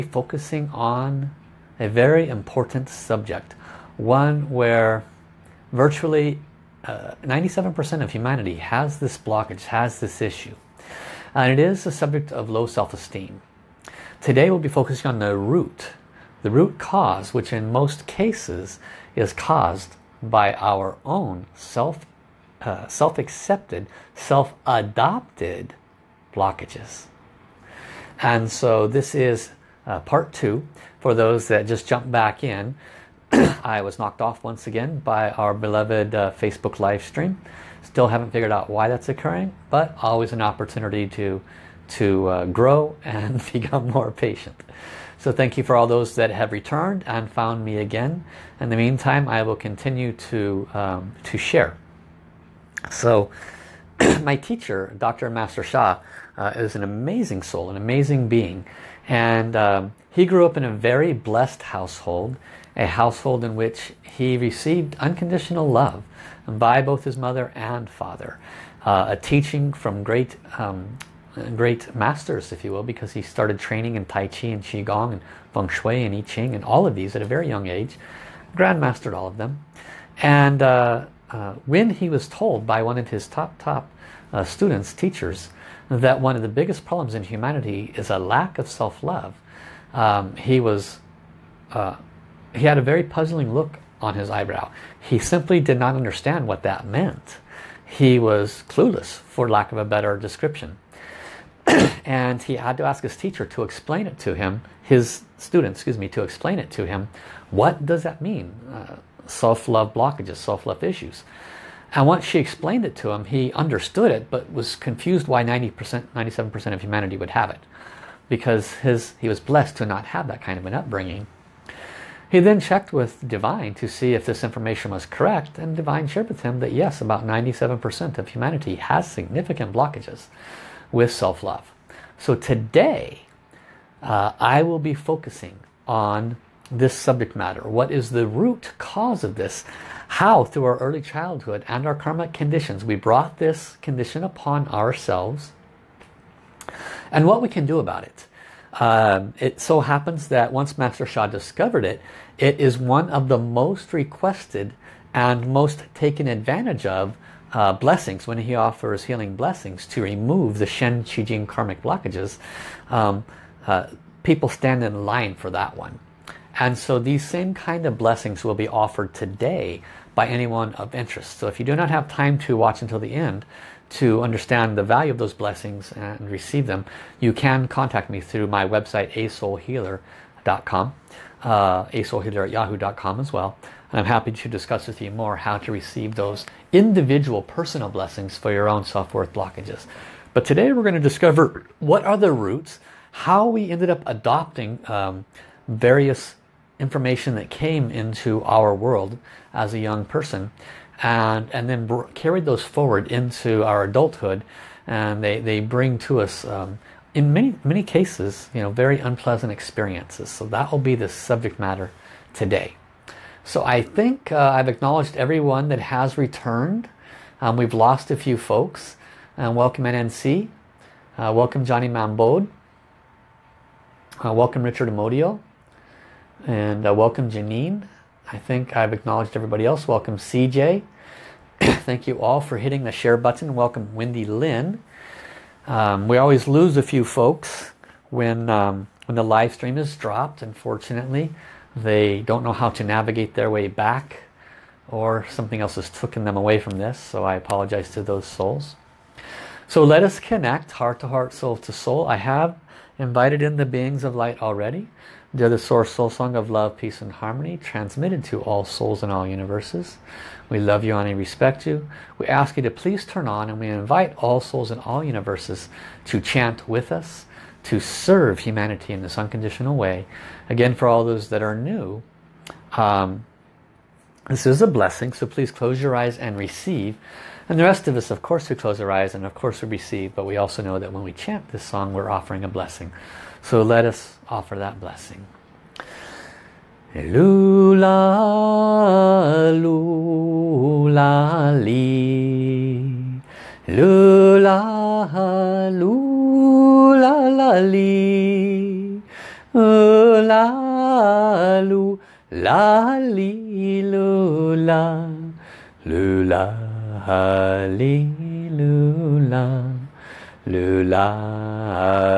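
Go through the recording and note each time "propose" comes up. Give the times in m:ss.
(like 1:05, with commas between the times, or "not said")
not said.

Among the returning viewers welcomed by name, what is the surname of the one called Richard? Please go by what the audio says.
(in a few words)
Amodio.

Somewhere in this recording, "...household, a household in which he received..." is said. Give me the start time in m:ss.
1:01.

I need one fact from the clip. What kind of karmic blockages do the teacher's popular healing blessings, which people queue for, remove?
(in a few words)
Shen Qi Jing.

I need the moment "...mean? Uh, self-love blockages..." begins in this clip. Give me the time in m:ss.
1:48.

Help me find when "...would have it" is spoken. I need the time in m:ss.
1:57.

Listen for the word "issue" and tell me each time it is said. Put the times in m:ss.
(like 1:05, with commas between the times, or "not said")
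0:10, 1:50.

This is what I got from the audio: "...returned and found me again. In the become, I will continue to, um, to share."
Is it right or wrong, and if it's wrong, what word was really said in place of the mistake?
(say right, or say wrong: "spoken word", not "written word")
wrong: "meantime", not "become".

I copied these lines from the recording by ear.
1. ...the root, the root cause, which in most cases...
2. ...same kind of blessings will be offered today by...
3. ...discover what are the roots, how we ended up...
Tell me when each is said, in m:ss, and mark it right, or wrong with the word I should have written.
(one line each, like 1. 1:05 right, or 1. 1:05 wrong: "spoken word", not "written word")
1. 0:15 right
2. 2:47 right
3. 3:11 right.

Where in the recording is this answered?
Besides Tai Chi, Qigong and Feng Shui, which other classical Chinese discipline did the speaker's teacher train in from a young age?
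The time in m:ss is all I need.
1:16.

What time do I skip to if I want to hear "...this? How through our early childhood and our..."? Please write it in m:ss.
2:19.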